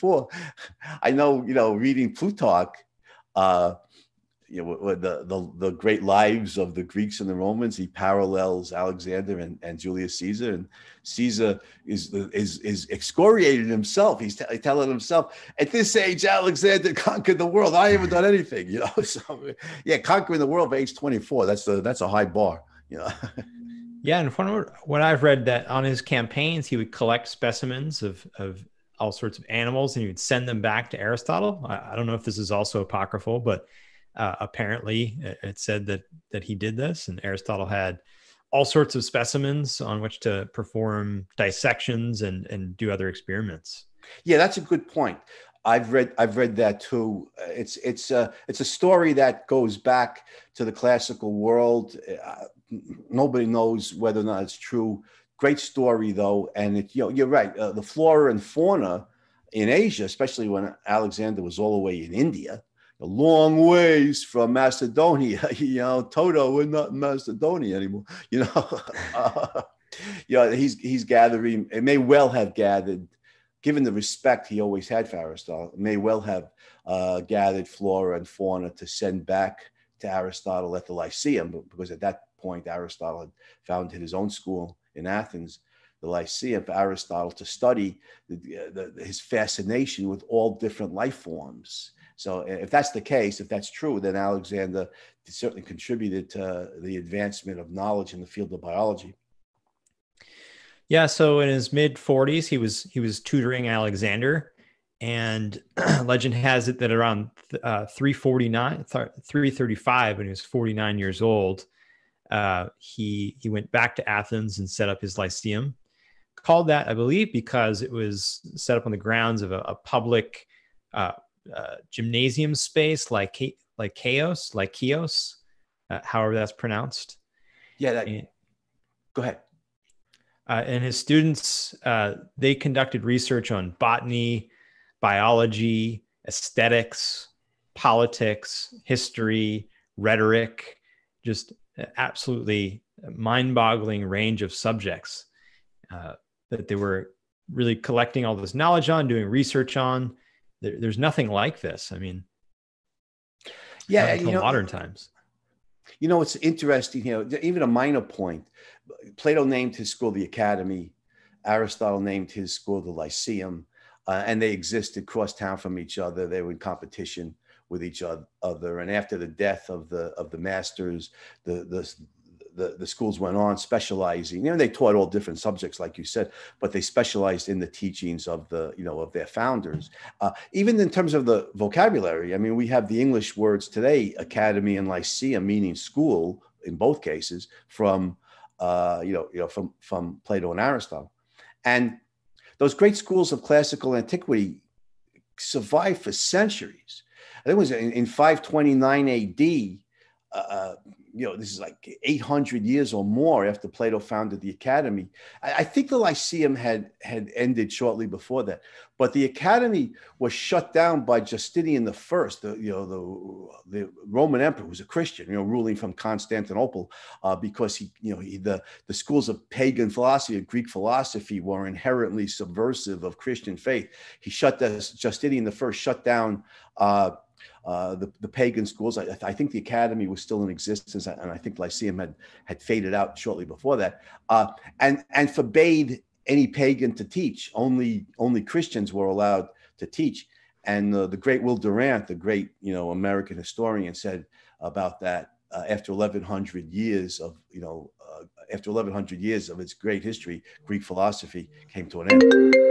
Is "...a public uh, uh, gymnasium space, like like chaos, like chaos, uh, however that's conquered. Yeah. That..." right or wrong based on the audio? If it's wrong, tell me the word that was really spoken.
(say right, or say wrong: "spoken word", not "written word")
wrong: "pronounced", not "conquered".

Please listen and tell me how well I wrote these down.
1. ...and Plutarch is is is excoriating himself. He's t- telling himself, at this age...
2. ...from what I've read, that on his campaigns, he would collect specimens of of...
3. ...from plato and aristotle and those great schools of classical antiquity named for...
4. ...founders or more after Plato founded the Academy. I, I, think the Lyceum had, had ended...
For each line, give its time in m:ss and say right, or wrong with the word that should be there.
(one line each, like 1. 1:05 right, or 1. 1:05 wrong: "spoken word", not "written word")
1. 0:10 wrong: "Caesar", not "Plutarch"
2. 0:24 right
3. 3:09 wrong: "survived", not "named"
4. 3:22 wrong: "years", not "founders".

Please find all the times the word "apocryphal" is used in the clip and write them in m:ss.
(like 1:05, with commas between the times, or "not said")
0:32.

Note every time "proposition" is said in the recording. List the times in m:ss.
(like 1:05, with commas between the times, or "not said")
not said.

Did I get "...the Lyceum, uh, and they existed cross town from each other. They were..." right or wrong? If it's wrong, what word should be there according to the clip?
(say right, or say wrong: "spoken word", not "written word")
right.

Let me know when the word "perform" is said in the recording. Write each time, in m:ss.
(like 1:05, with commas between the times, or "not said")
0:40.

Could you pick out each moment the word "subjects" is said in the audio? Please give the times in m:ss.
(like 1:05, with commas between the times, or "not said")
2:24, 2:55.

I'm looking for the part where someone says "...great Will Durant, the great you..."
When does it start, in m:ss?
4:01.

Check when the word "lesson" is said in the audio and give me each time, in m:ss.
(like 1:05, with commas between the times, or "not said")
not said.